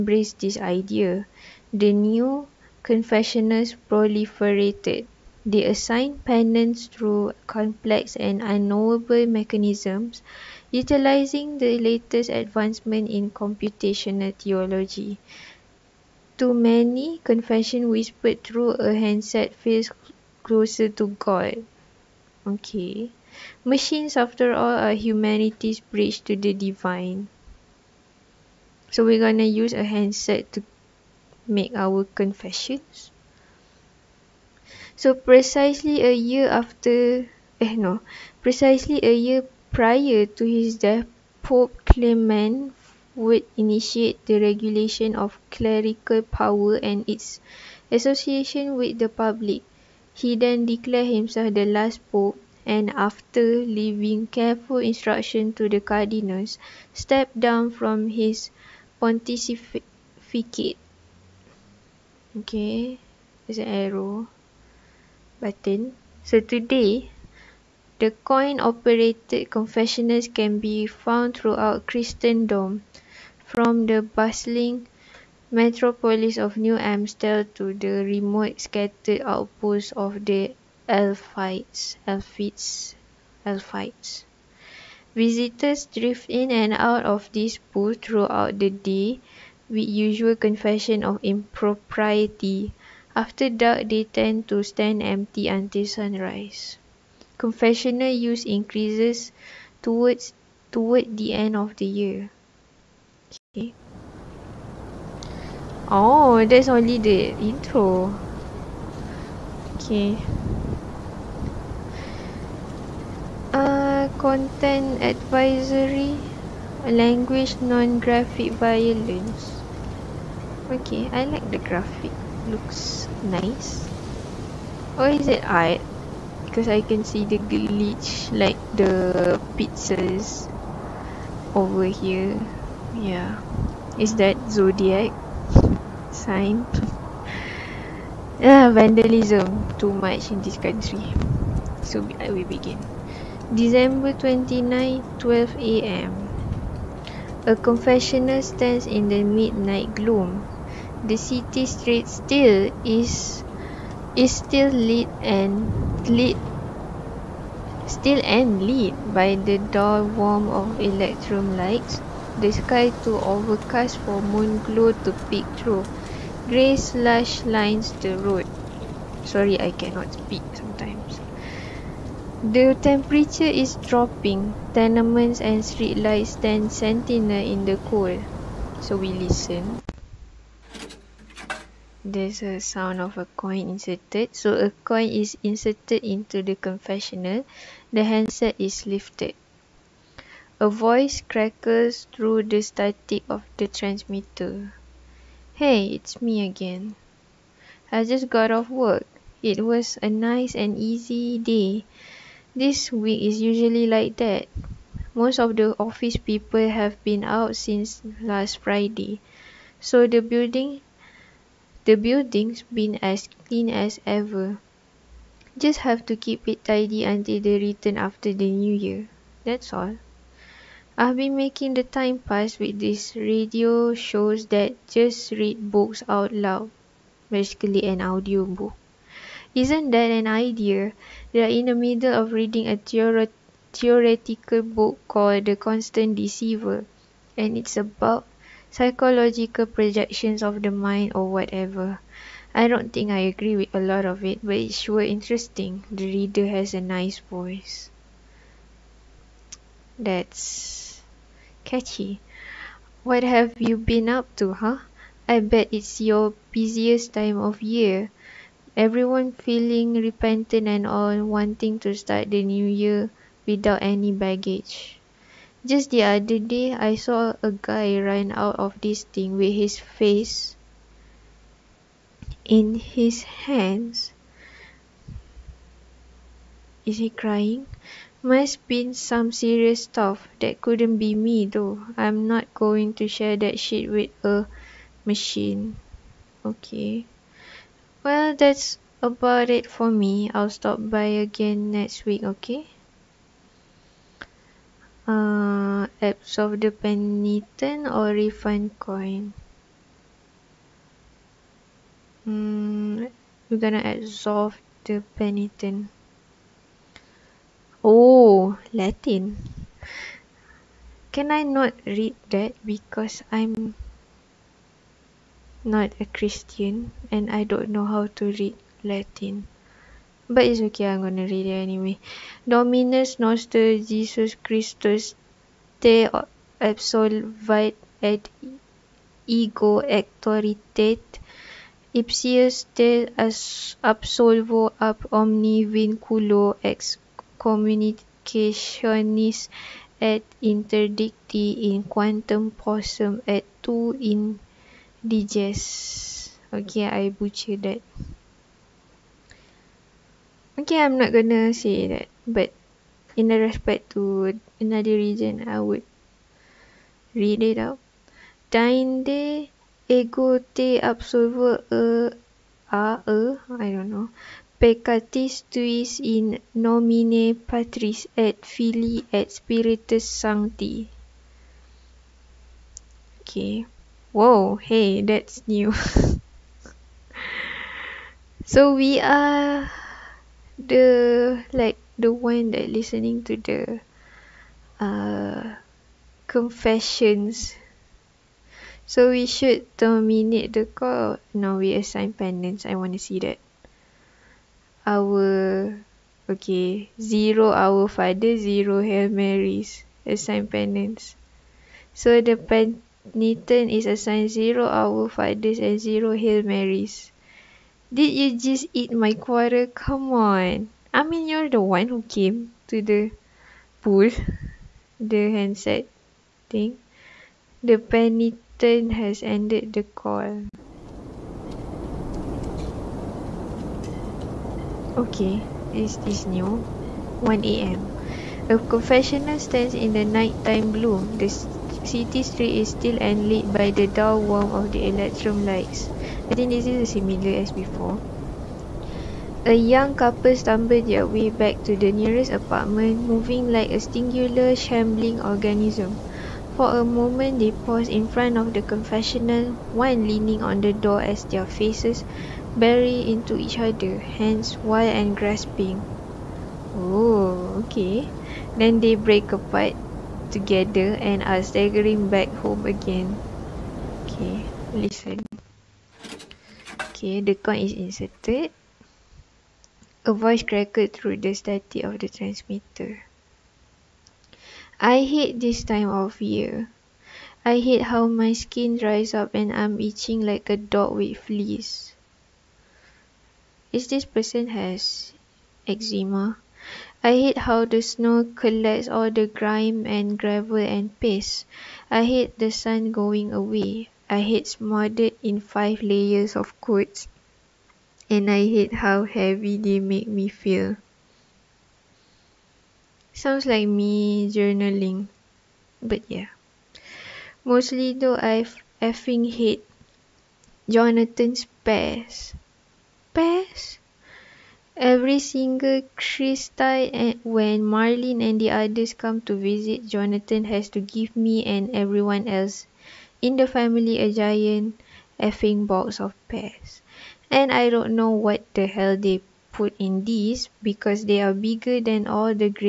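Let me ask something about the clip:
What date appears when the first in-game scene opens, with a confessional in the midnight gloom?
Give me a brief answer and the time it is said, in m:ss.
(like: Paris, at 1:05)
December 29, at 2:23.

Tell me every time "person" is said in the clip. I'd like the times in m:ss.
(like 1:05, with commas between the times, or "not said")
8:04.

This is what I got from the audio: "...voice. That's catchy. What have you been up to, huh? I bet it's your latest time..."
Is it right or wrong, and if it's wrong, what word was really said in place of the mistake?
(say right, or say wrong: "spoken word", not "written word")
wrong: "busiest", not "latest".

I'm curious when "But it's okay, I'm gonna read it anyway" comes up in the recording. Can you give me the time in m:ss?
5:20.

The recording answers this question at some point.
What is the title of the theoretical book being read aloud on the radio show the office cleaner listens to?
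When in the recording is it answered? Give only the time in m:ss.
3:55.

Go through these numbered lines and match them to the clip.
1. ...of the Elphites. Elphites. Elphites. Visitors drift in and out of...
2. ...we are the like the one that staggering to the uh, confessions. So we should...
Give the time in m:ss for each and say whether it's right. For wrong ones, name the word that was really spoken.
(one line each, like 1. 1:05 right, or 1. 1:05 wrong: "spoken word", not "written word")
1. 1:19 right
2. 6:18 wrong: "listening", not "staggering".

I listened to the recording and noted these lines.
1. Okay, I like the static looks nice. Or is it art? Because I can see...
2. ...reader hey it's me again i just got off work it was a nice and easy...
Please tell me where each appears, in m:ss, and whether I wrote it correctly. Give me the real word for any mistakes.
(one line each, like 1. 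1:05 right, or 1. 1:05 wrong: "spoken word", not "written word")
1. 2:00 wrong: "graphic", not "static"
2. 3:13 wrong: "transmitter", not "reader".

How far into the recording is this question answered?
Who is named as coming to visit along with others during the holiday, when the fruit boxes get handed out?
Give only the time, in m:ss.
8:37.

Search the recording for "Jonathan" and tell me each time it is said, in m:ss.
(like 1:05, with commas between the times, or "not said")
8:30, 8:39.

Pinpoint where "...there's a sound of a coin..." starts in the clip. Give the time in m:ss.
3:02.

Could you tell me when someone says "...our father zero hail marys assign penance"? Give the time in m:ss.
6:37.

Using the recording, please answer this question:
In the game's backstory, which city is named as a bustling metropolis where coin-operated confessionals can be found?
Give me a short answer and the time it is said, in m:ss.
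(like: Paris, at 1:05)
New Amstel, at 1:16.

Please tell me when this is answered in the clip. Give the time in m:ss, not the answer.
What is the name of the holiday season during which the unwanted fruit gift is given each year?
8:35.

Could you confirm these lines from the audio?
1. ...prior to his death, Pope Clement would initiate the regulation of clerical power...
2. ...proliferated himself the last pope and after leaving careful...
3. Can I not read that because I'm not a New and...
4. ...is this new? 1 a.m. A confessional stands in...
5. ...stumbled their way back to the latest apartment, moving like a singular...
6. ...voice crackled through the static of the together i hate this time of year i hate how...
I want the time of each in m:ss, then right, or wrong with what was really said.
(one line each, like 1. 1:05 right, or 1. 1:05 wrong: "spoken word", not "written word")
1. 0:39 right
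2. 0:50 wrong: "declared", not "proliferated"
3. 5:11 wrong: "Christian", not "New"
4. 7:05 right
5. 7:20 wrong: "nearest", not "latest"
6. 7:50 wrong: "transmitter", not "together".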